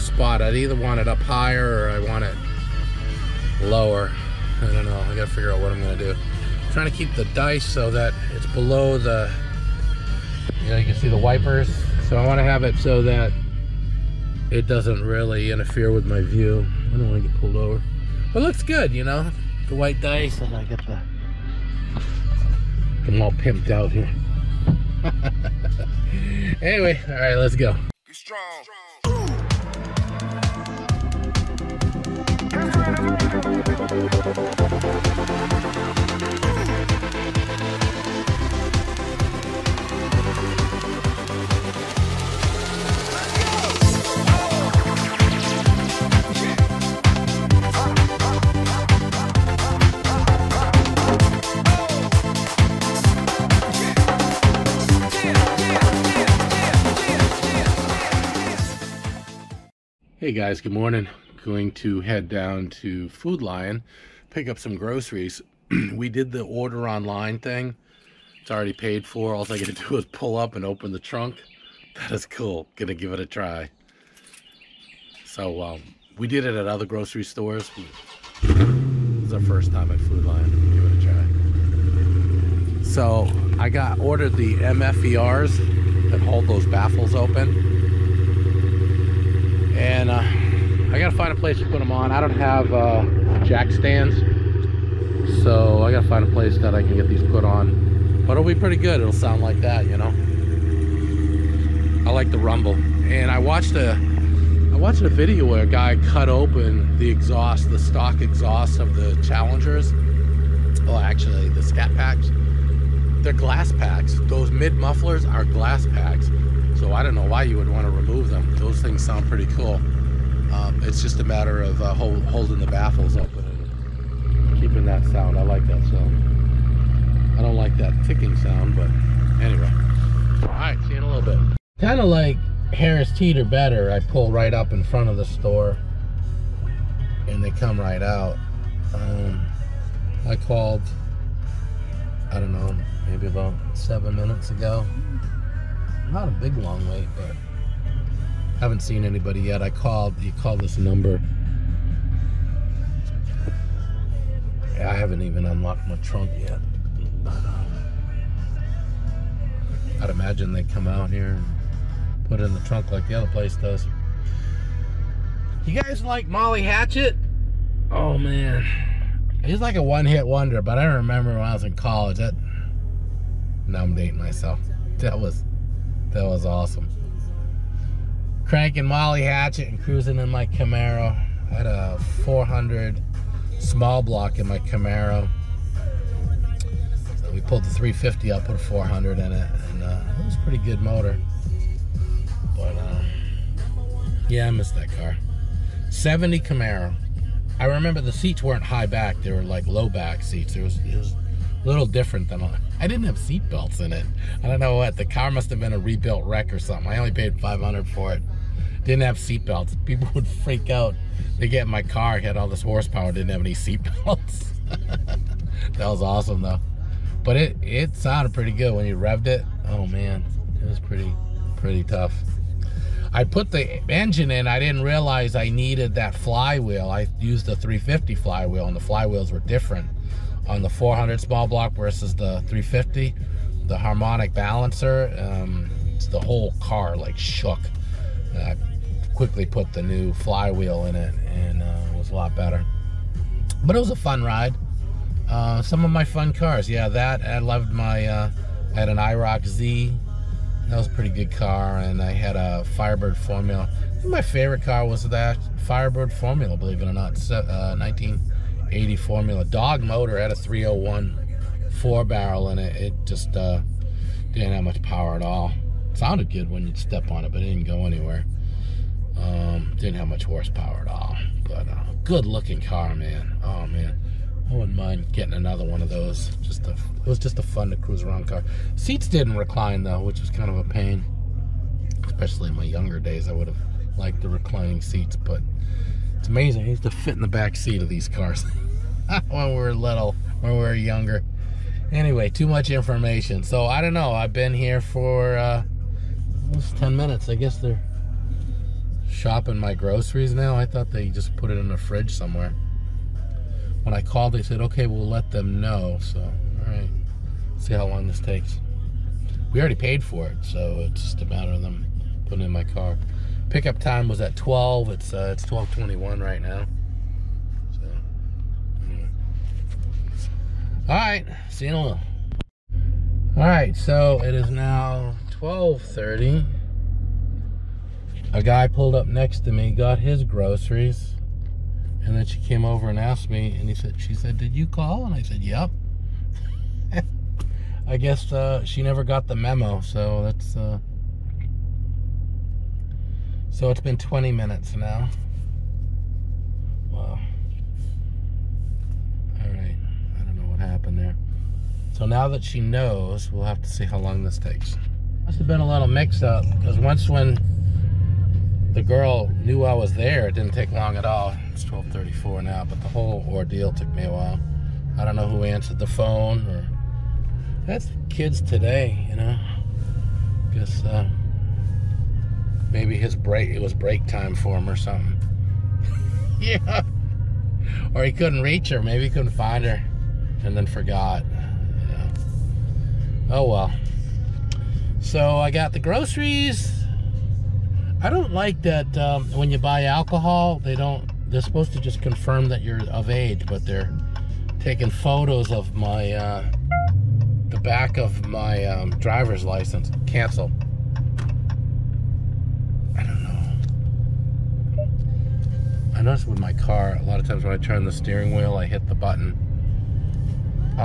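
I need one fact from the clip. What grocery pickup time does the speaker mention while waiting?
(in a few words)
12.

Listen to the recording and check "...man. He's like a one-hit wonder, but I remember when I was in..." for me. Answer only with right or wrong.
right.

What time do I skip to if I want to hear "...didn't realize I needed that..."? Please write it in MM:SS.
03:44.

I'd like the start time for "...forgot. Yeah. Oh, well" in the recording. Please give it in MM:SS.
06:20.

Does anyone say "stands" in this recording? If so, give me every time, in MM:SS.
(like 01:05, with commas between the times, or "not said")
01:33.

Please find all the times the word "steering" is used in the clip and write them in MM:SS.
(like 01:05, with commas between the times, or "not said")
06:47.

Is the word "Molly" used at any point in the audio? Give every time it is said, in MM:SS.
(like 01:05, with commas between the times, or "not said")
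02:46, 02:58.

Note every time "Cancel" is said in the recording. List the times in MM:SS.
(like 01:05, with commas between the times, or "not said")
06:40.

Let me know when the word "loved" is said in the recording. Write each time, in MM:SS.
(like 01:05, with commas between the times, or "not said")
04:07.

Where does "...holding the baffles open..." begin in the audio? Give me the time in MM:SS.
02:02.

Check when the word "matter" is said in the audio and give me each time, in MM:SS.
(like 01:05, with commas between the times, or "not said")
02:01, 05:11.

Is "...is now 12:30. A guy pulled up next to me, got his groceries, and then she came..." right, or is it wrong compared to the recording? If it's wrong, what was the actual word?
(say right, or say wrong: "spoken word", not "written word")
right.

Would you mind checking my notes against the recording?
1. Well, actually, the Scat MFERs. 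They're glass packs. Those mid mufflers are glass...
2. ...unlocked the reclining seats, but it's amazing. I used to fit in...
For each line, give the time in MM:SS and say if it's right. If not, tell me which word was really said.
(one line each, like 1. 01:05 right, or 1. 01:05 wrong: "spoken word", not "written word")
1. 01:50 wrong: "Packs", not "MFERs"
2. 04:43 wrong: "liked", not "unlocked".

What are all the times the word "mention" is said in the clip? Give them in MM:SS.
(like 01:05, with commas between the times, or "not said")
not said.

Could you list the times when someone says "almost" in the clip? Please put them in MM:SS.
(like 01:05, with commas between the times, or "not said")
04:56.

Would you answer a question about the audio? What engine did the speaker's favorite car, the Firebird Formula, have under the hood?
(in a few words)
301 four barrel.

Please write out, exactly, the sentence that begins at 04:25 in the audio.
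It sounded good when you'd step on it, but it didn't go anywhere.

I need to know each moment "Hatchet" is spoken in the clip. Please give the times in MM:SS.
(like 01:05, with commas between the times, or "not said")
02:46, 02:59.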